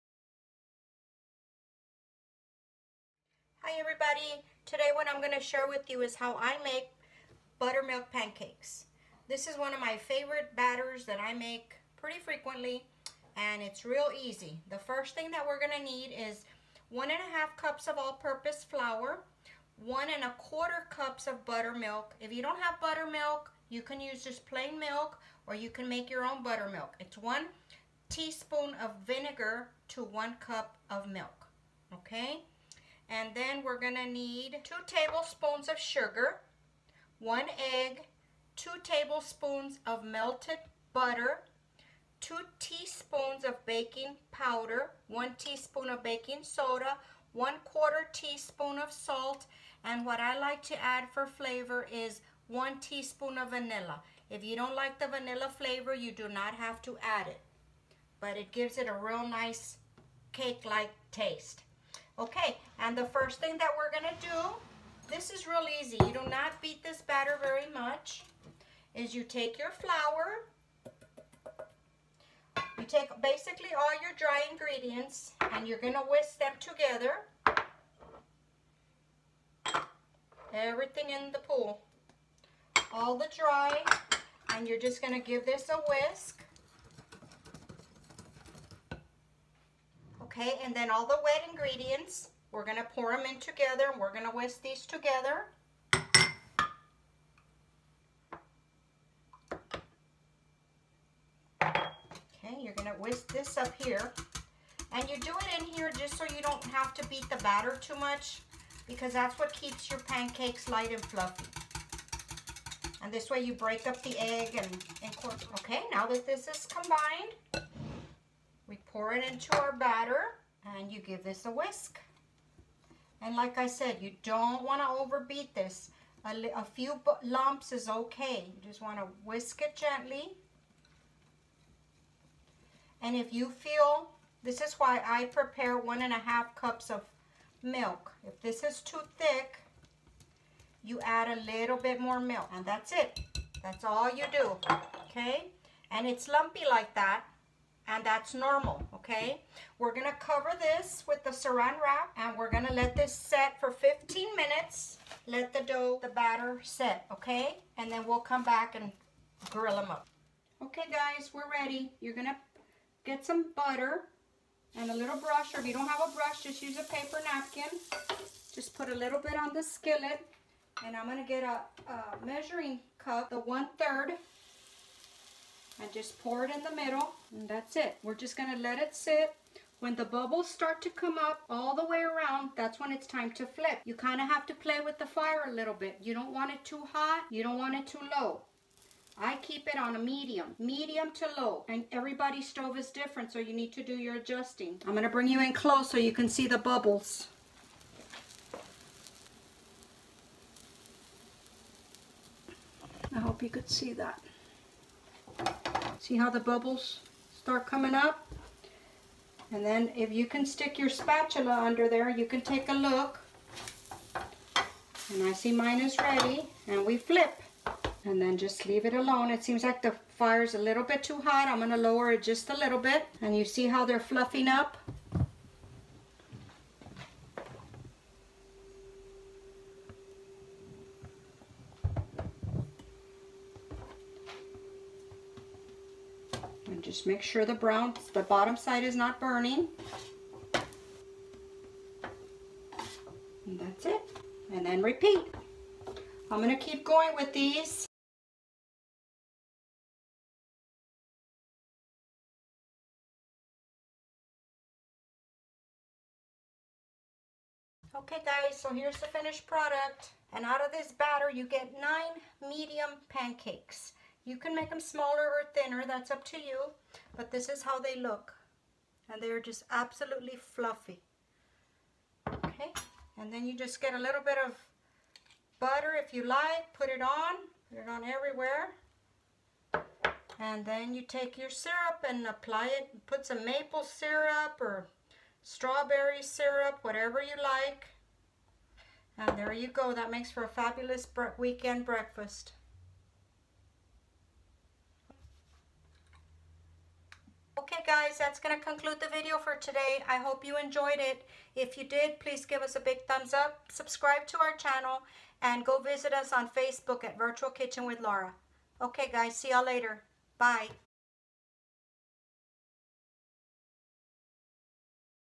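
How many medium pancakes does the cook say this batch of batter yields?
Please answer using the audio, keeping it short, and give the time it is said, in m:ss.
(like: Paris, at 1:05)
9, at 4:21.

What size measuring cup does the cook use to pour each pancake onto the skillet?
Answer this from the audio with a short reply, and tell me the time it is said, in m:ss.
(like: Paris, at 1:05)
one third, at 2:53.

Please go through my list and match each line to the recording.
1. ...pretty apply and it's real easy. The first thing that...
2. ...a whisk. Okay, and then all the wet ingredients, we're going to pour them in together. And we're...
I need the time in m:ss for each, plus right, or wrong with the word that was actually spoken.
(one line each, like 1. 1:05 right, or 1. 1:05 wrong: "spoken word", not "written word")
1. 0:11 wrong: "frequently", not "apply"
2. 1:25 right.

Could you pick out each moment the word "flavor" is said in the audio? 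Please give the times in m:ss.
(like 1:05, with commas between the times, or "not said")
0:51, 0:55.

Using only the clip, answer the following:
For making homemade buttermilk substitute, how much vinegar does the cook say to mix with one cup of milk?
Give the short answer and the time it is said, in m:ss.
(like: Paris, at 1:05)
1 teaspoon, at 0:27.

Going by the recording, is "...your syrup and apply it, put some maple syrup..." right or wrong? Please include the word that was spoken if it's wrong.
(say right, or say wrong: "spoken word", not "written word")
right.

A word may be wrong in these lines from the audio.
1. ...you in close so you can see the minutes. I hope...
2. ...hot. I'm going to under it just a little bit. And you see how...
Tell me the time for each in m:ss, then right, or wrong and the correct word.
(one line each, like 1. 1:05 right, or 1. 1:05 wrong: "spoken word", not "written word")
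1. 3:15 wrong: "bubbles", not "minutes"
2. 3:41 wrong: "lower", not "under".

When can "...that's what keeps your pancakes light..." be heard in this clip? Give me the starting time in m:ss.
1:49.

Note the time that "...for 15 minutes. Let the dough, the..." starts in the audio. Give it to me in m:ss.
2:33.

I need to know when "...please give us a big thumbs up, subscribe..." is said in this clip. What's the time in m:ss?
5:02.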